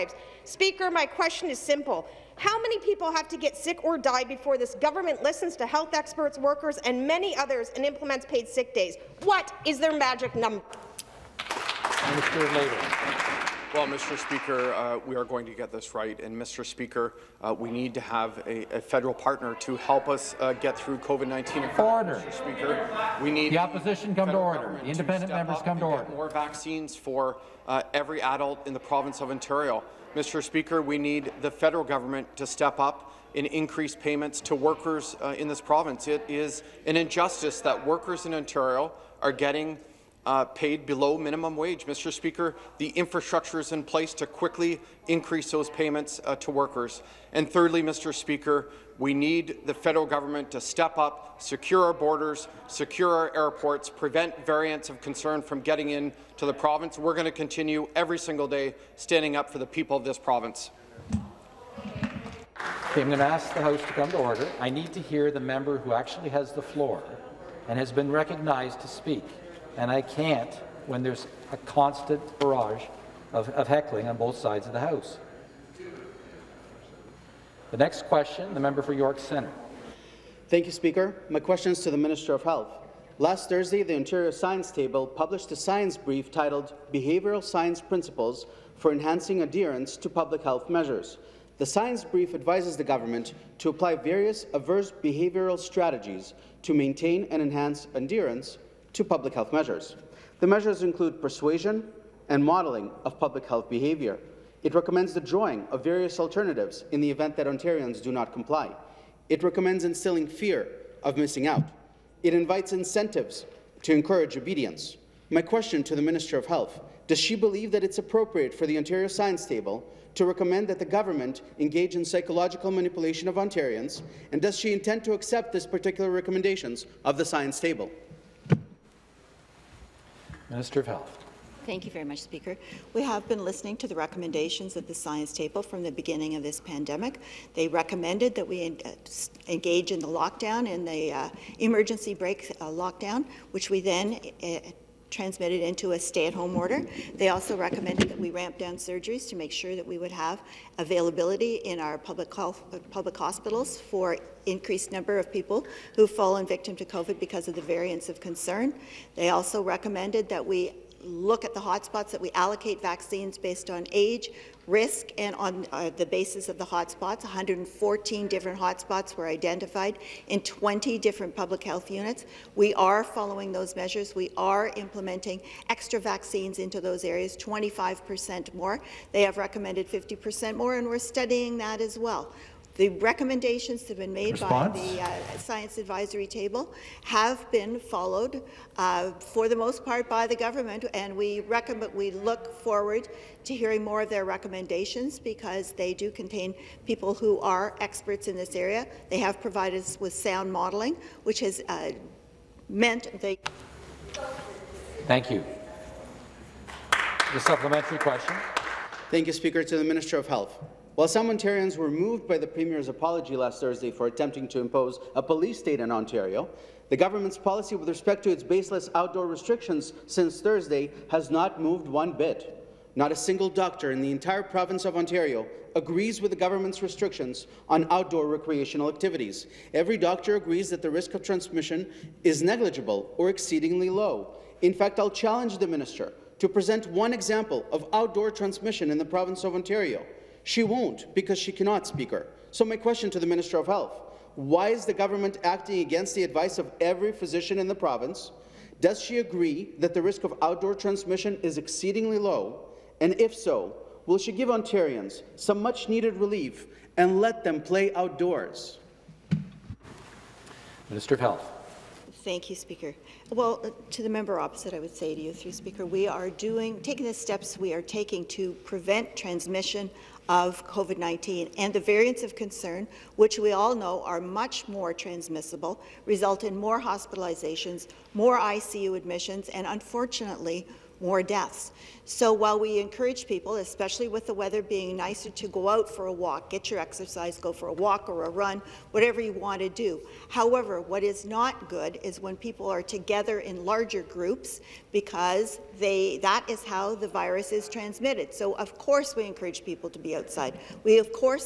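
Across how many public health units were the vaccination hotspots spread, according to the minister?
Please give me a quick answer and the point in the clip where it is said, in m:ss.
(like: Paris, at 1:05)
20, at 2:50.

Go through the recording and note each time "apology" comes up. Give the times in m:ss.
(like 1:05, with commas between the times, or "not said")
3:32.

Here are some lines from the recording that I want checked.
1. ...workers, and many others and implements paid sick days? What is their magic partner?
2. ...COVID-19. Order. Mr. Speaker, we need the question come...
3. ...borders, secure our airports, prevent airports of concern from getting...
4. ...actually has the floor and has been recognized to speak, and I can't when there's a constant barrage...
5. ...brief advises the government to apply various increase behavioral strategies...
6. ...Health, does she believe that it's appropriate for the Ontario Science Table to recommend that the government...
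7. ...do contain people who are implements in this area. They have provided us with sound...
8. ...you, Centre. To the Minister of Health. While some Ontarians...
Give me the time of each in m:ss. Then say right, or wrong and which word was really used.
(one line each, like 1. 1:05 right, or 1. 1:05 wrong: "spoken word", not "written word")
1. 0:06 wrong: "number", not "partner"
2. 0:20 wrong: "opposition", not "question"
3. 0:51 wrong: "variants", not "airports"
4. 1:05 right
5. 1:32 wrong: "adverse", not "increase"
6. 1:56 right
7. 3:15 wrong: "experts", not "implements"
8. 3:29 wrong: "Speaker", not "Centre".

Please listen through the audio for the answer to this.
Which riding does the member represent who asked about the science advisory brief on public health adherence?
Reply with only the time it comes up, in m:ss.
1:18.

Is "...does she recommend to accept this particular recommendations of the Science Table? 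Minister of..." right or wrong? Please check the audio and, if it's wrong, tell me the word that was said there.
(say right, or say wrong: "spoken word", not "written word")
wrong: "intend", not "recommend".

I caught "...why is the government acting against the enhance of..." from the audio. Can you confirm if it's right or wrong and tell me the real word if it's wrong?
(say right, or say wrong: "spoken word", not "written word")
wrong: "advice", not "enhance".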